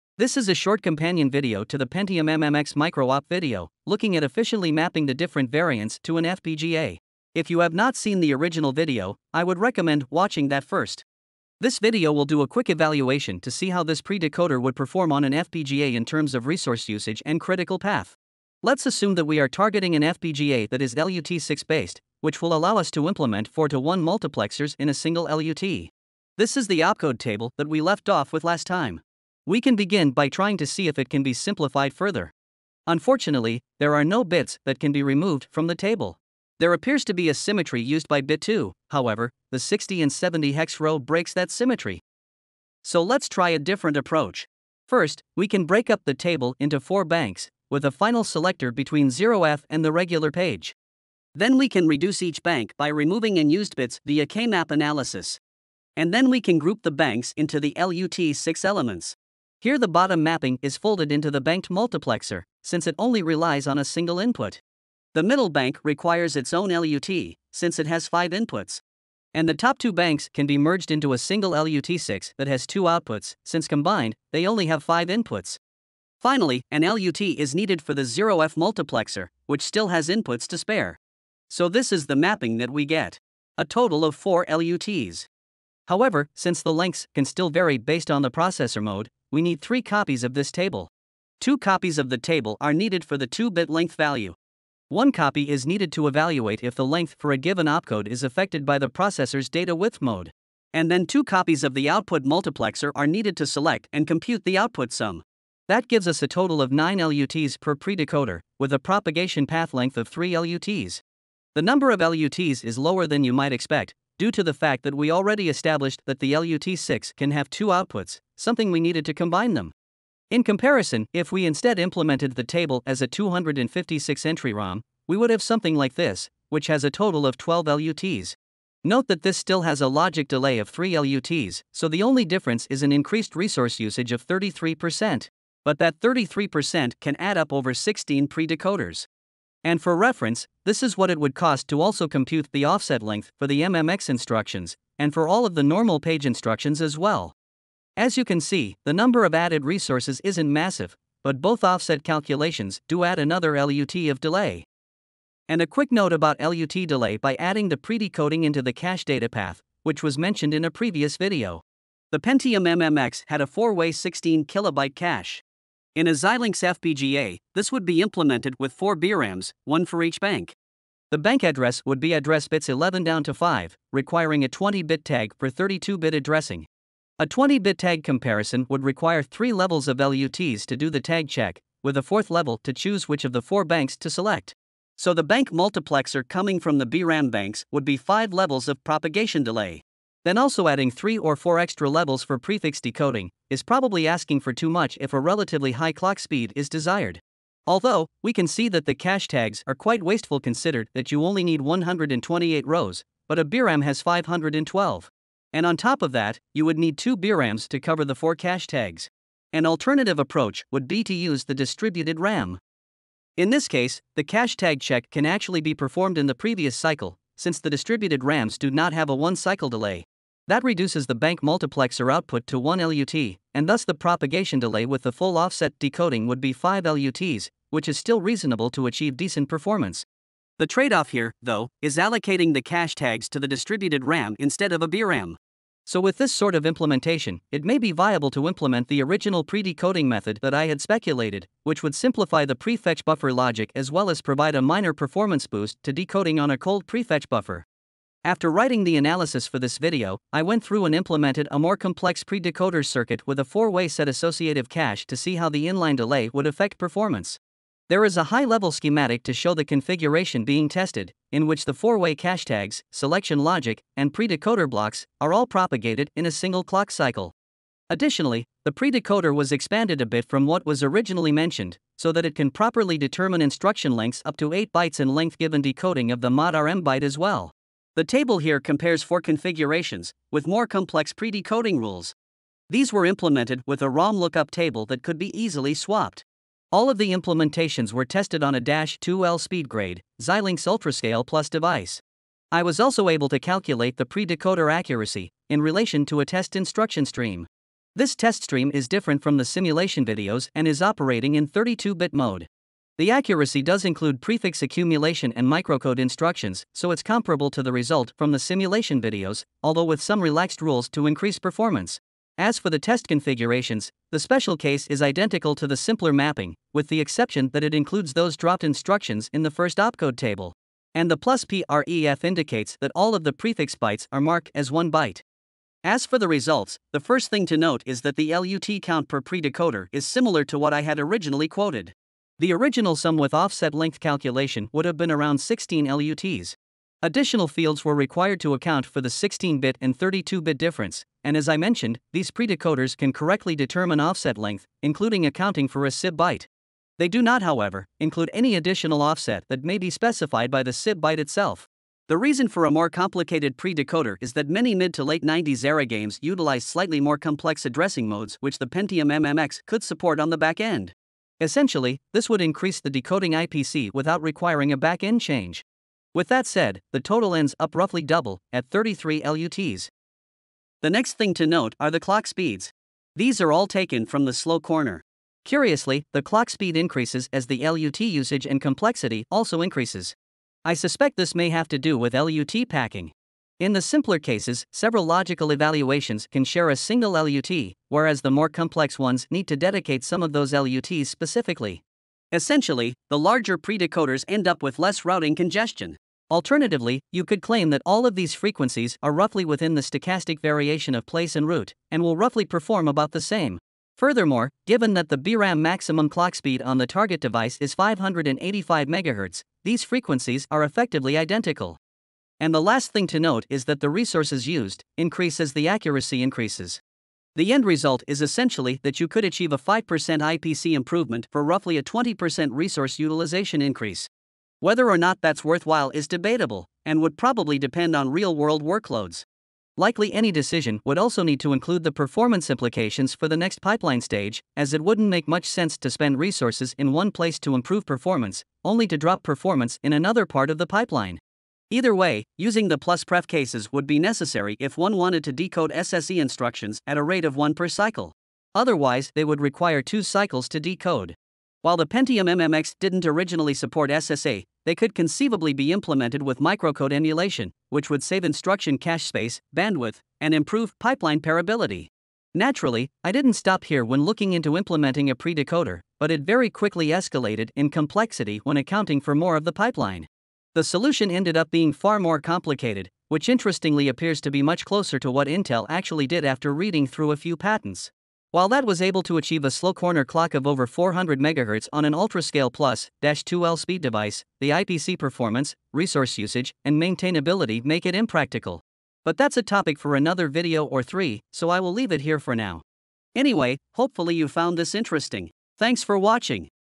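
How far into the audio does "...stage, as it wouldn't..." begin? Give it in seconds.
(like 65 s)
434 s.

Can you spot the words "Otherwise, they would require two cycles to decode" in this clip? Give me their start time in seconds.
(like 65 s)
448 s.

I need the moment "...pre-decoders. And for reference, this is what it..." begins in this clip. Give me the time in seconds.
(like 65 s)
138 s.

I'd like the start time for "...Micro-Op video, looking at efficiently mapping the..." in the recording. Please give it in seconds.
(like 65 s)
2 s.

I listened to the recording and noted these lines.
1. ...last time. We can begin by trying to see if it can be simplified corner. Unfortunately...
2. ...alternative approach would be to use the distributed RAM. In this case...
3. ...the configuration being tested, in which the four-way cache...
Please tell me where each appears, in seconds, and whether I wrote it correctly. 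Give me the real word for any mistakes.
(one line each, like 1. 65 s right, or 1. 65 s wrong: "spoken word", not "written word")
1. 28 s wrong: "further", not "corner"
2. 209 s right
3. 259 s right.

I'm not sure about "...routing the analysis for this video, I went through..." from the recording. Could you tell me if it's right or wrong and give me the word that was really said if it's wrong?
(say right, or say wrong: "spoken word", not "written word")
wrong: "writing", not "routing".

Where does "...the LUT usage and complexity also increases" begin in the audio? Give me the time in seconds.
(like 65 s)
377 s.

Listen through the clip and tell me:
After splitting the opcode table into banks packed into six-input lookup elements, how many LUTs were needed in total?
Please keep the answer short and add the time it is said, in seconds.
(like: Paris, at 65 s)
4, at 83 s.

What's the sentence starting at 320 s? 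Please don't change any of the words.
And the plus PREF indicates that all of the prefix bytes are marked as one byte.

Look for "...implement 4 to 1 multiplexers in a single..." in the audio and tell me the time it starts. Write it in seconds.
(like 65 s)
23 s.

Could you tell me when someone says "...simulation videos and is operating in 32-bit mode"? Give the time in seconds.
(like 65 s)
299 s.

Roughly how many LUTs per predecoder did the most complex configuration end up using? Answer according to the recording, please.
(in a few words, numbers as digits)
33.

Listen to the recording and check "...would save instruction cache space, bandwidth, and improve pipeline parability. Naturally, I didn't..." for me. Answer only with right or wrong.
right.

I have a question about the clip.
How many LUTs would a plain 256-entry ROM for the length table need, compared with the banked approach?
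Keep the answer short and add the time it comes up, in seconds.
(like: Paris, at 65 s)
12, at 126 s.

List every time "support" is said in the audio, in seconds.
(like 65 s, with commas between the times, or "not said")
359 s, 453 s.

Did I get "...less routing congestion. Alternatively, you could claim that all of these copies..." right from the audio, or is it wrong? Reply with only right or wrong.
wrong.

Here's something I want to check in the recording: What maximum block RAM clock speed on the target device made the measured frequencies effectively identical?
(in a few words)
585 MHz.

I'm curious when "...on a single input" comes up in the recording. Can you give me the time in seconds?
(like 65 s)
63 s.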